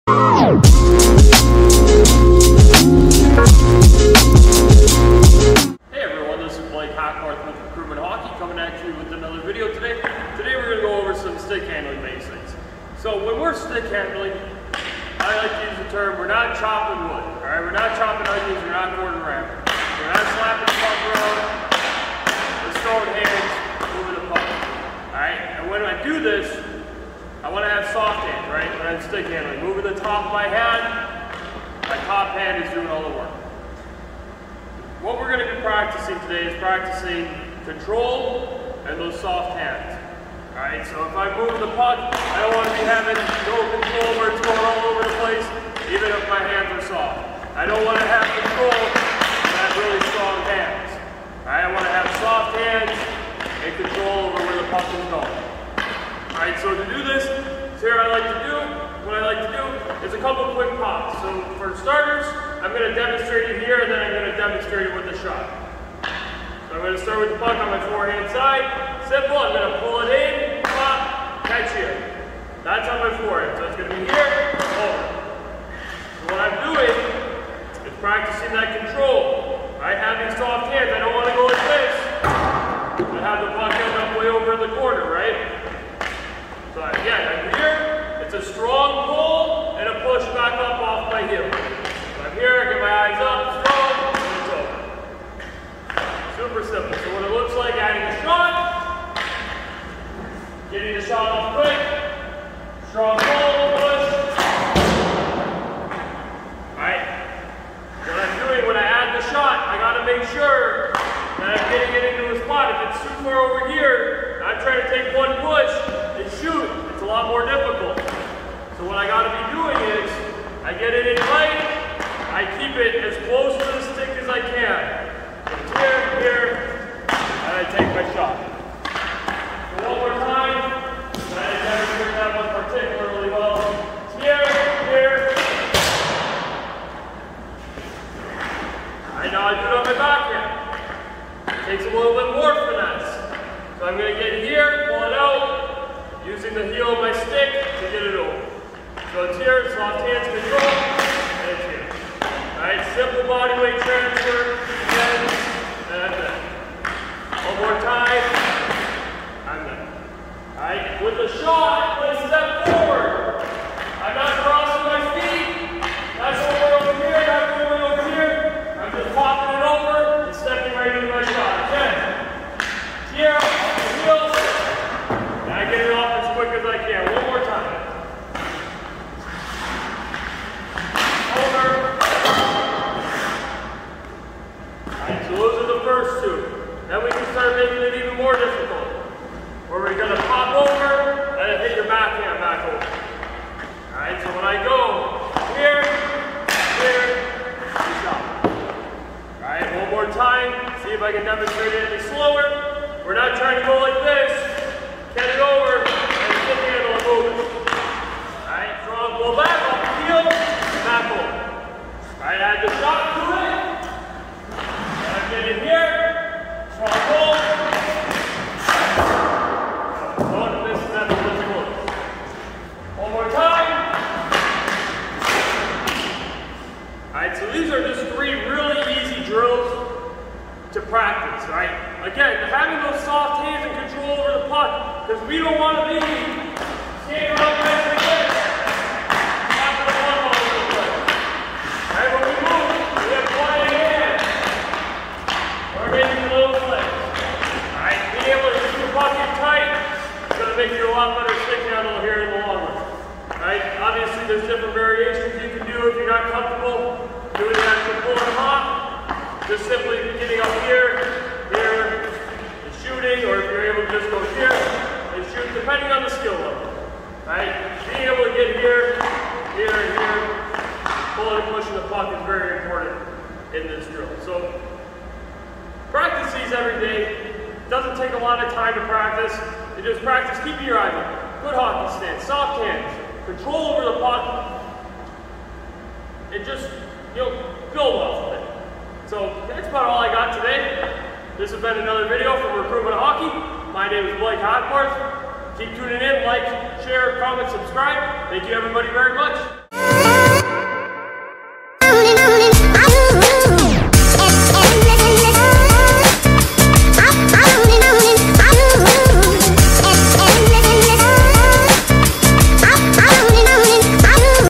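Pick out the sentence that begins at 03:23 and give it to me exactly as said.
We're not trying to go like this.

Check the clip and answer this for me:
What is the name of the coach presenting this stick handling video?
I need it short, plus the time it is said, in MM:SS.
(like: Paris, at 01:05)
Blake Hackbarth, at 04:54.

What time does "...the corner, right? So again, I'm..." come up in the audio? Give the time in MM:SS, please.
01:24.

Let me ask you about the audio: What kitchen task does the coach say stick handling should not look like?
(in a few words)
Chopping onions.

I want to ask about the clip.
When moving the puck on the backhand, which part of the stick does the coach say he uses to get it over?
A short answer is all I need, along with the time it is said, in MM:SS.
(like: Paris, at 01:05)
The heel, at 02:26.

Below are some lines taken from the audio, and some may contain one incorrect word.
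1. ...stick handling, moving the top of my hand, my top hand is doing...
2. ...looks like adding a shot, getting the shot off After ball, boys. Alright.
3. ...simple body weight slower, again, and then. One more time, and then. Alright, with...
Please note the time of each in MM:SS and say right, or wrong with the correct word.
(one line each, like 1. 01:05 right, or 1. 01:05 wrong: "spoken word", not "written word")
1. 00:29 right
2. 01:37 wrong: "Strong", not "After"
3. 02:32 wrong: "transfer", not "slower".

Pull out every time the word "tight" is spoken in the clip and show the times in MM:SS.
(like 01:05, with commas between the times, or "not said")
02:01, 04:09.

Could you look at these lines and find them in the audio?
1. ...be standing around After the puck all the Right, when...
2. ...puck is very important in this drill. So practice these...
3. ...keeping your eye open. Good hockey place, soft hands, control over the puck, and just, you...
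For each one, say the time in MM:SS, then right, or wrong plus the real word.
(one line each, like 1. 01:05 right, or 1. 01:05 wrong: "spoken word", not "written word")
1. 03:55 right
2. 04:31 right
3. 04:40 wrong: "stance", not "place".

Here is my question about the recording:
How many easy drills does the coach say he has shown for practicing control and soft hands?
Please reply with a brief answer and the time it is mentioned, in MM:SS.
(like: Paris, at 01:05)
3, at 03:48.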